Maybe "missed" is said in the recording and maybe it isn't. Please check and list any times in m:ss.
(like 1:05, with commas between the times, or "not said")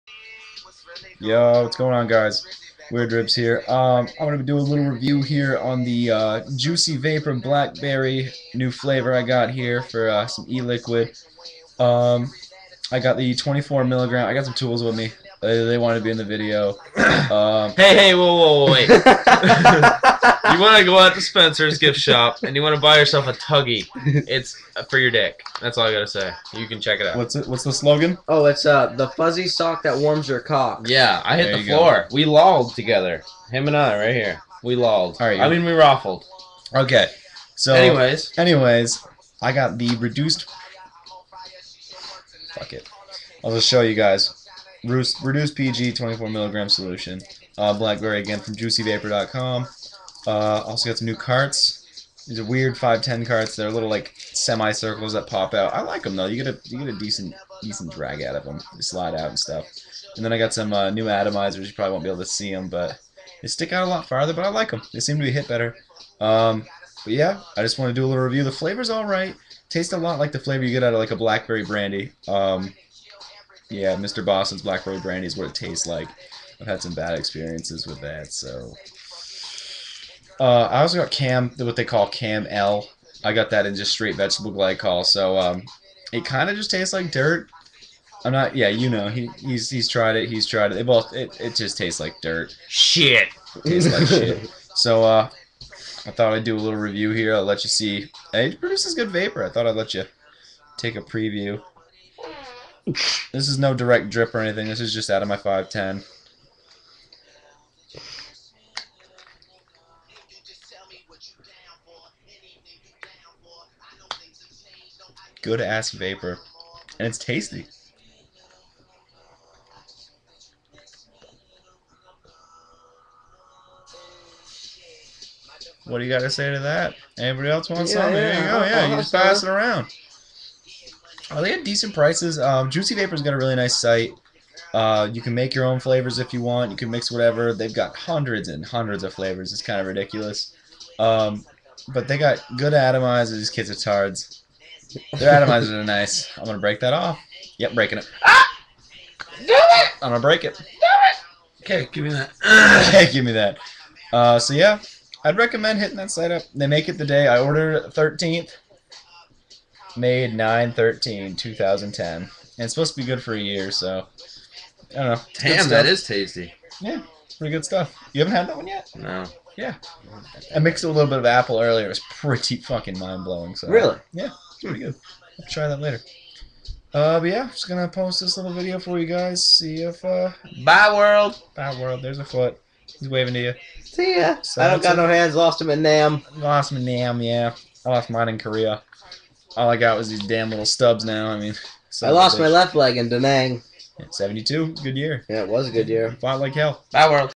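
not said.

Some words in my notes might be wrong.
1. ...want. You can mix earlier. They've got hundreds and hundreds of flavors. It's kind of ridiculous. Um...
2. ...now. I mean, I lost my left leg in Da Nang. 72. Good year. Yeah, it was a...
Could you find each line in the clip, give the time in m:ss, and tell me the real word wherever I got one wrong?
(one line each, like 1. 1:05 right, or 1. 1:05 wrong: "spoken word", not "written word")
1. 2:16 wrong: "whatever", not "earlier"
2. 3:11 right.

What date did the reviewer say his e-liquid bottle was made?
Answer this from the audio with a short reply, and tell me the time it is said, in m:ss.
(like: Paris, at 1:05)
9-13, 2010, at 2:40.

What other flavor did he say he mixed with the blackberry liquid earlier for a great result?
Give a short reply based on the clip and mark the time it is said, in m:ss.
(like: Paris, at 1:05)
apple, at 2:51.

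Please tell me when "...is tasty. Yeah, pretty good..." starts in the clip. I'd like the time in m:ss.
2:45.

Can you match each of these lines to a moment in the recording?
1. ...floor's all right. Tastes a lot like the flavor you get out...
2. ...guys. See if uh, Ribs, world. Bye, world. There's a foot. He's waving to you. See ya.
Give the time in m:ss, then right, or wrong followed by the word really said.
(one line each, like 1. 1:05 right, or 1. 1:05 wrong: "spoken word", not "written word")
1. 1:08 wrong: "flavor", not "floor"
2. 2:59 wrong: "Bye", not "Ribs".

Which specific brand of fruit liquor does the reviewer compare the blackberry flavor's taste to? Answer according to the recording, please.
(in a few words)
Mr. Boston's.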